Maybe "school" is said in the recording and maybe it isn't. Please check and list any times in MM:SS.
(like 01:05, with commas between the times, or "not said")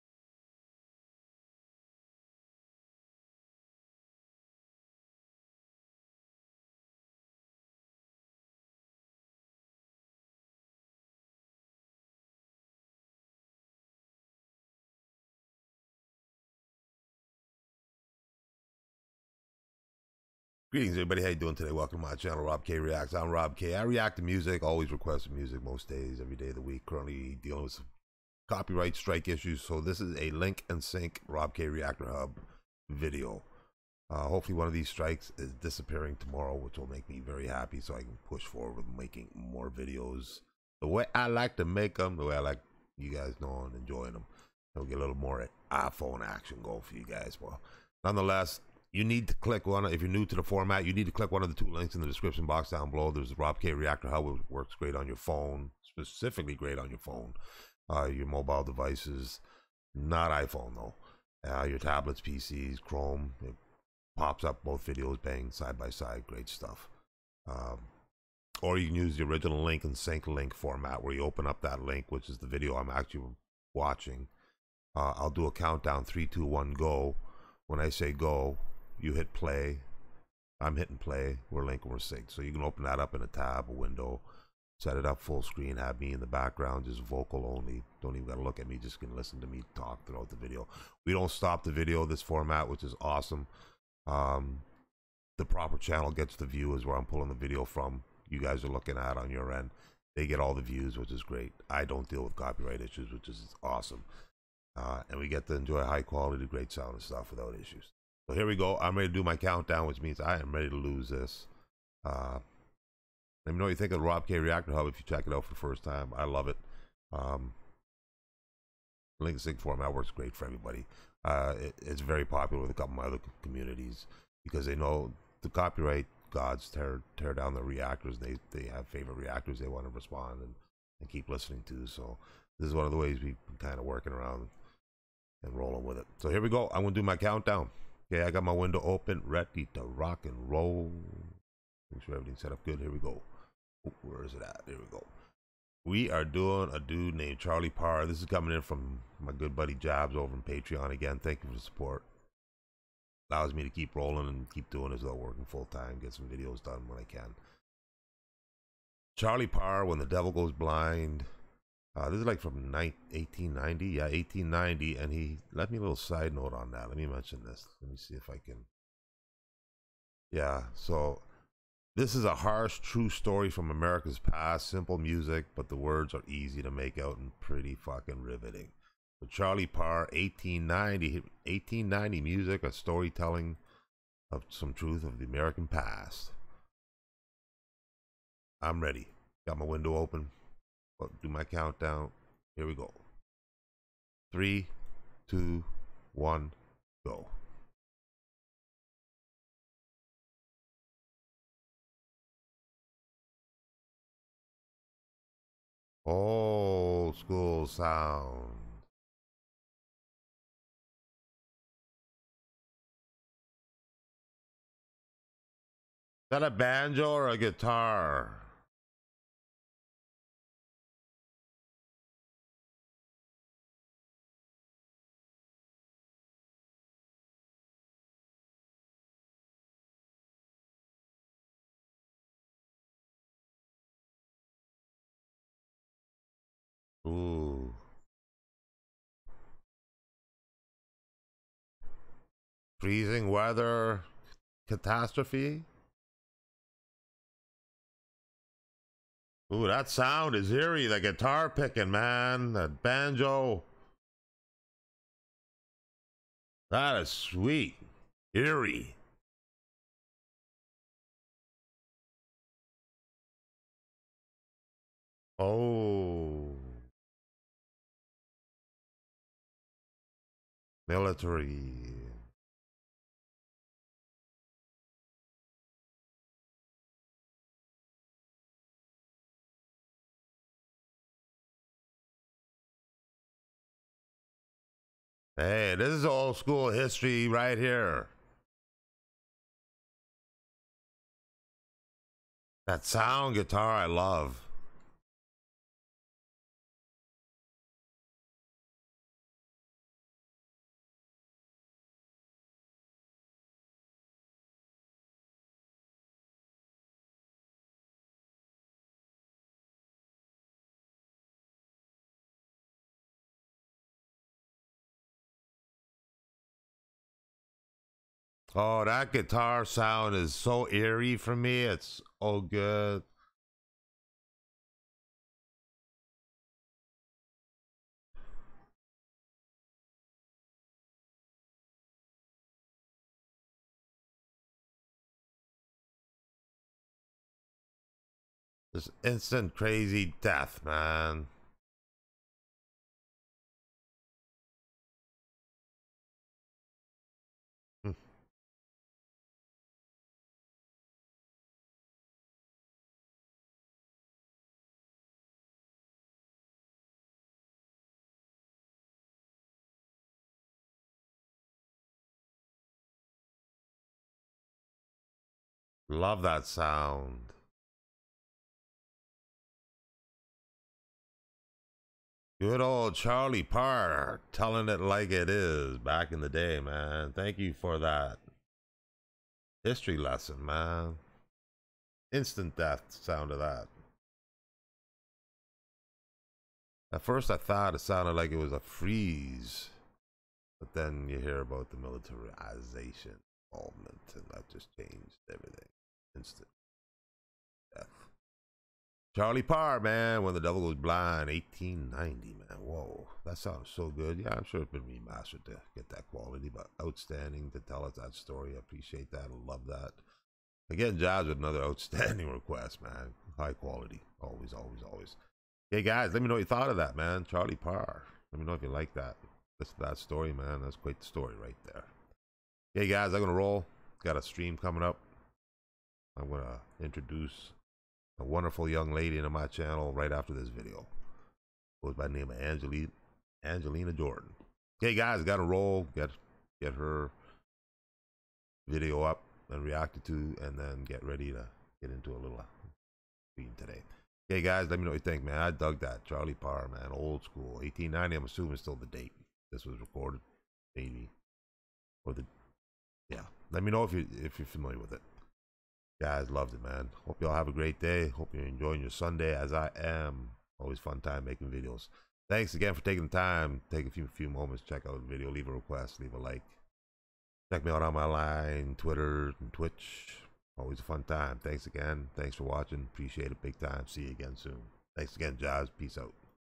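03:27, 04:46, 07:27.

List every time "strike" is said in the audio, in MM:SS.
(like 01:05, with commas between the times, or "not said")
00:28, 00:34.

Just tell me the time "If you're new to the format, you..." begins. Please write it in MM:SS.
00:49.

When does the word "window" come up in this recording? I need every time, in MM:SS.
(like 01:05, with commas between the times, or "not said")
01:23, 02:18, 03:09.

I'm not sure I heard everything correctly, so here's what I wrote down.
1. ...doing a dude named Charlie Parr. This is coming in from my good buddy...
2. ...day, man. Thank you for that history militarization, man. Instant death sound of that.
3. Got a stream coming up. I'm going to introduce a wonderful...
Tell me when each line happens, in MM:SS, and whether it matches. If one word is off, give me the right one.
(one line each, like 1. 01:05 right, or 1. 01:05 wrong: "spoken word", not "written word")
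1. 02:26 right
2. 06:16 wrong: "lesson", not "militarization"
3. 07:04 right.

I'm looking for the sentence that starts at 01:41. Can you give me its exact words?
I don't deal with copyright issues, which is awesome.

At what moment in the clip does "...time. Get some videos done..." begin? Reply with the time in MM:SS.
02:35.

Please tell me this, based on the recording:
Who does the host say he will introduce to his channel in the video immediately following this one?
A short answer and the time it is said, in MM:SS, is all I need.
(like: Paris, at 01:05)
Angelina Jordan, at 07:13.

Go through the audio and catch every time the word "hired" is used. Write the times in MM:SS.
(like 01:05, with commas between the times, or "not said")
not said.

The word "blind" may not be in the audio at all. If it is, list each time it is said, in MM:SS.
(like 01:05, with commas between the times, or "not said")
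02:40, 06:40.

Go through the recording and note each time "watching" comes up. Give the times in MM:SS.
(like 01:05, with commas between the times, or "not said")
01:13, 07:52.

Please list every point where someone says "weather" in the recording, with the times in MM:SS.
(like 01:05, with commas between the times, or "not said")
04:03.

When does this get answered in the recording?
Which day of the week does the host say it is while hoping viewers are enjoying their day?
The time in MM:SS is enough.
07:38.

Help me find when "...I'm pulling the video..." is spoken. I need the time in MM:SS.
01:36.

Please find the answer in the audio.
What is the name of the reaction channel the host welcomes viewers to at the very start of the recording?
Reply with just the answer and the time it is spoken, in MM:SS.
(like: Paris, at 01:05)
Rob K Reacts, at 00:22.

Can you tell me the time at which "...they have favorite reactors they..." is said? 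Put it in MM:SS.
02:08.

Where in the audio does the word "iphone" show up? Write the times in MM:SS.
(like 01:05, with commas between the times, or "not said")
00:45, 01:00.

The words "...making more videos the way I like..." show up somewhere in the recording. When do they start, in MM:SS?
00:38.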